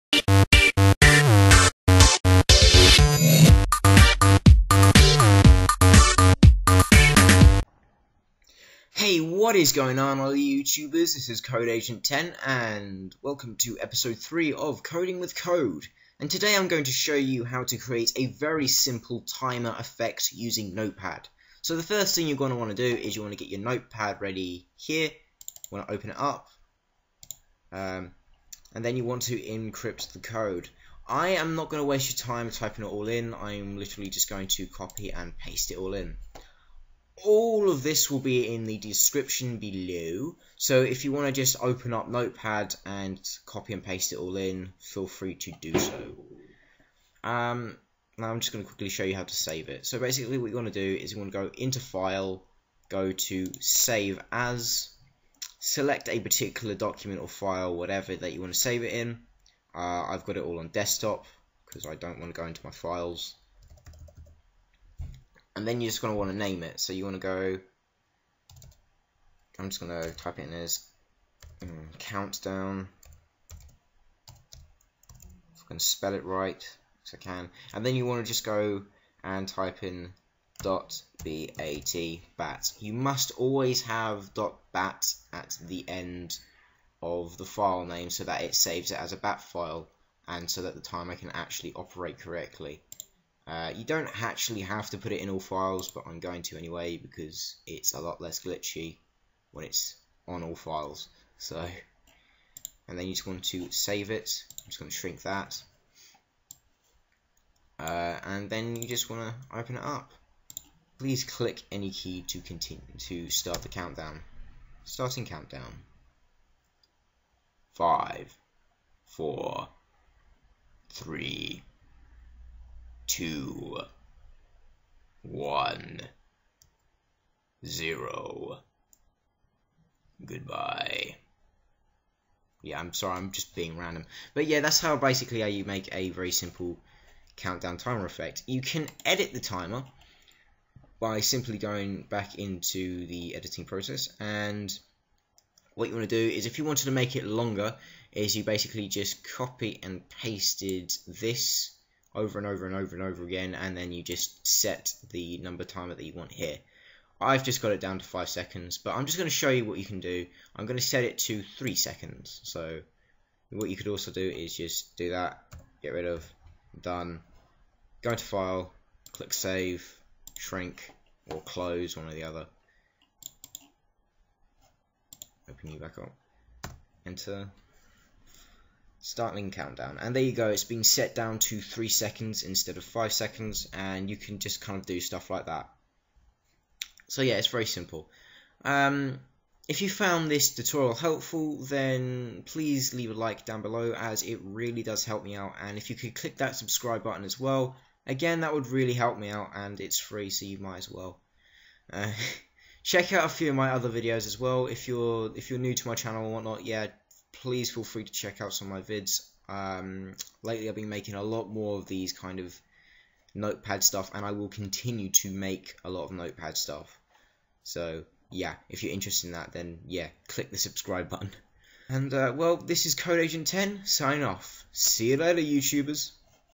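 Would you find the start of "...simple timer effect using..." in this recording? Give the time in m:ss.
0:18.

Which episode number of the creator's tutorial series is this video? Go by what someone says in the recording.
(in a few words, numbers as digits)
3.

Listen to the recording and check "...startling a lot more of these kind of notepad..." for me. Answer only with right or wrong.
wrong.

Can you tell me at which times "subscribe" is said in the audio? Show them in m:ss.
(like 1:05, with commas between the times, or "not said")
3:16, 3:40.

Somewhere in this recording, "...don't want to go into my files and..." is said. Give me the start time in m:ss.
1:01.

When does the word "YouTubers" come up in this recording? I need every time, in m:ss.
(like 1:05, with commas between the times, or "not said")
0:10, 3:45.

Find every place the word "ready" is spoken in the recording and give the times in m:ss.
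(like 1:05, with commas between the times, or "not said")
0:24.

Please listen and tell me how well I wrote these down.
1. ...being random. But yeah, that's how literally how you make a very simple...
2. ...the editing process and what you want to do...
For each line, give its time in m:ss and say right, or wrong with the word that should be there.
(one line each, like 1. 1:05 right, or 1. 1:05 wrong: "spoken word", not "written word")
1. 2:13 wrong: "basically", not "literally"
2. 2:23 right.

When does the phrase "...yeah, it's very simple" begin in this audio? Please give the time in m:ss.
3:07.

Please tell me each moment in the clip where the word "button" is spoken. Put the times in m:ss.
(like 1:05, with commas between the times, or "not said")
3:17, 3:41.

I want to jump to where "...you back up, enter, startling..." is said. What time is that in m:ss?
2:55.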